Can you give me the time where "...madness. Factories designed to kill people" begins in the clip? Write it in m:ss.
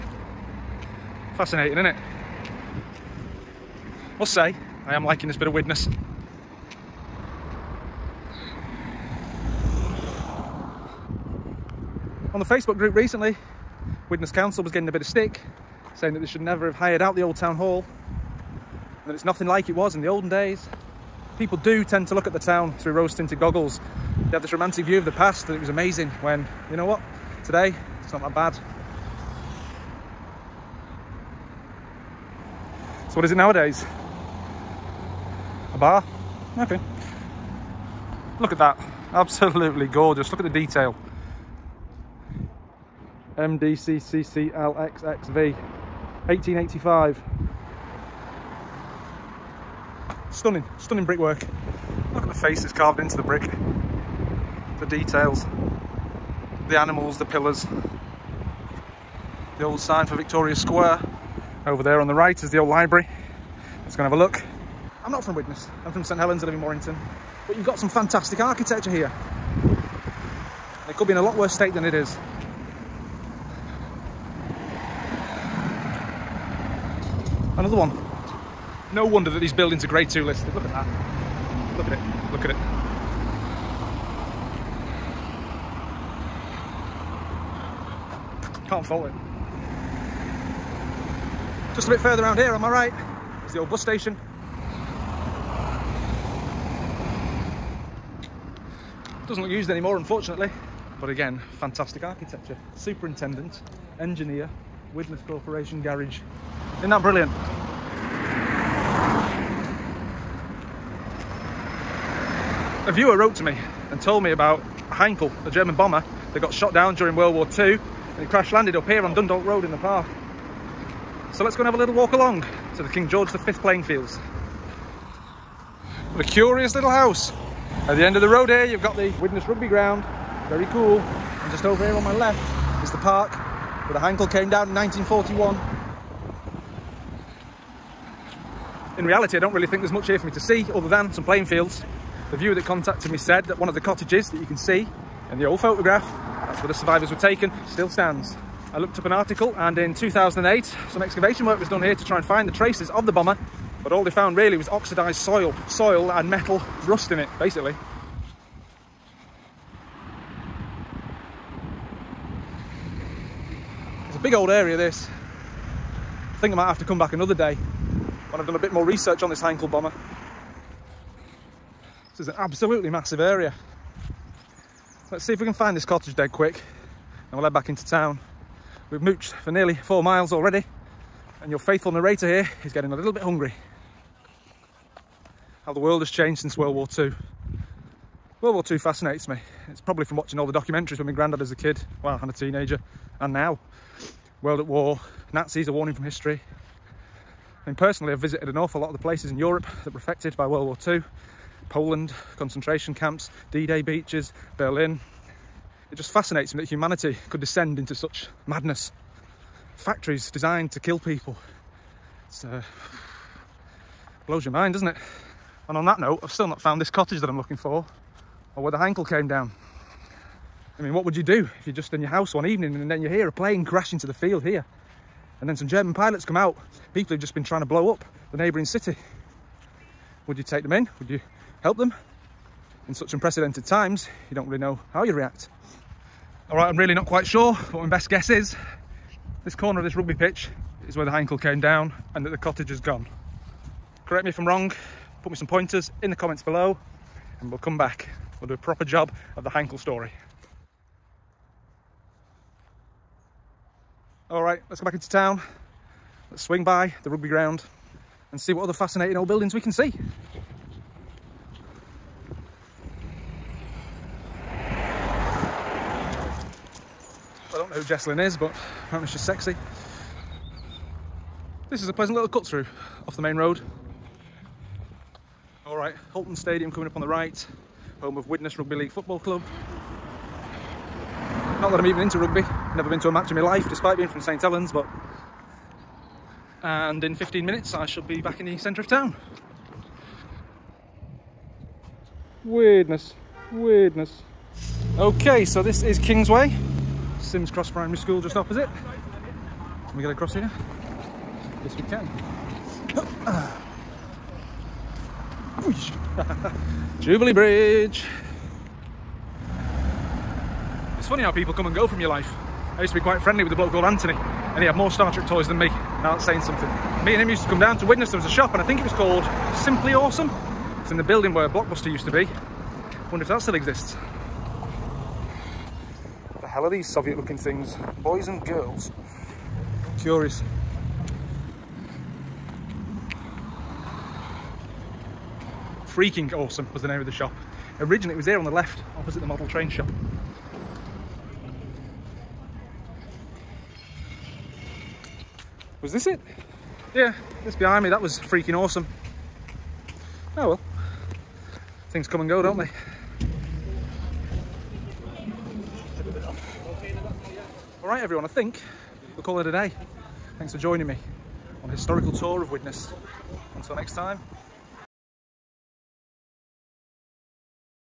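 3:28.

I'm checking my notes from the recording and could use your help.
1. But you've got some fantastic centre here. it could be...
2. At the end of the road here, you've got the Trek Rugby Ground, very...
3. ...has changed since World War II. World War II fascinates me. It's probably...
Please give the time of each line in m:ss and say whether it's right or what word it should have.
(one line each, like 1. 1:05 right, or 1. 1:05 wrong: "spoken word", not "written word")
1. 1:07 wrong: "architecture", not "centre"
2. 2:07 wrong: "Widnes", not "Trek"
3. 3:06 right.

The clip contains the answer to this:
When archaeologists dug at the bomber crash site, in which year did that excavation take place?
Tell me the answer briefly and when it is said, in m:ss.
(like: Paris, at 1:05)
2008, at 2:29.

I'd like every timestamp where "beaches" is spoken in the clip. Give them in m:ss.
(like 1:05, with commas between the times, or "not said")
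3:23.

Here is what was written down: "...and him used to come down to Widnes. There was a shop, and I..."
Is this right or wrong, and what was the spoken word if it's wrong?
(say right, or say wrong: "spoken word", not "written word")
right.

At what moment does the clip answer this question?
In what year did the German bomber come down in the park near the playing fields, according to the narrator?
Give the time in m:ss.
2:14.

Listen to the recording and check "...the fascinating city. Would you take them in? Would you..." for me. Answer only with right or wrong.
wrong.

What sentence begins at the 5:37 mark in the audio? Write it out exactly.
Originally it was here on the left, opposite the model train shop.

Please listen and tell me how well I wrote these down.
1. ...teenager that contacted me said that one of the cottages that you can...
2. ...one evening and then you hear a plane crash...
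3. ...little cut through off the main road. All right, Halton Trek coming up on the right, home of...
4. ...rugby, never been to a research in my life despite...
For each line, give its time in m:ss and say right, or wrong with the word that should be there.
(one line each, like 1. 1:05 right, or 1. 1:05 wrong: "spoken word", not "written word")
1. 2:22 wrong: "viewer", not "teenager"
2. 3:42 right
3. 4:32 wrong: "Stadium", not "Trek"
4. 4:42 wrong: "match", not "research".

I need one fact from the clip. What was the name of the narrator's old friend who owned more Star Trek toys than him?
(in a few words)
Anthony.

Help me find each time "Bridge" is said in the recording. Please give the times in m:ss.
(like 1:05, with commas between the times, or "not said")
5:07.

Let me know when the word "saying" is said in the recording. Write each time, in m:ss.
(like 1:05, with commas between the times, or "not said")
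0:15, 5:16.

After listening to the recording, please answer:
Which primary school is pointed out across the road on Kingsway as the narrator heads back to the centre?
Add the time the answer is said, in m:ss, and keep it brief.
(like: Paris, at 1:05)
Simms Cross Primary School, at 4:57.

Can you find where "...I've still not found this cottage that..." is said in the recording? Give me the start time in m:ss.
3:36.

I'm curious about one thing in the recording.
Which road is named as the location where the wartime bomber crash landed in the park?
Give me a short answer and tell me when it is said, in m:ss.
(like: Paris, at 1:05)
Dundalk Road, at 1:59.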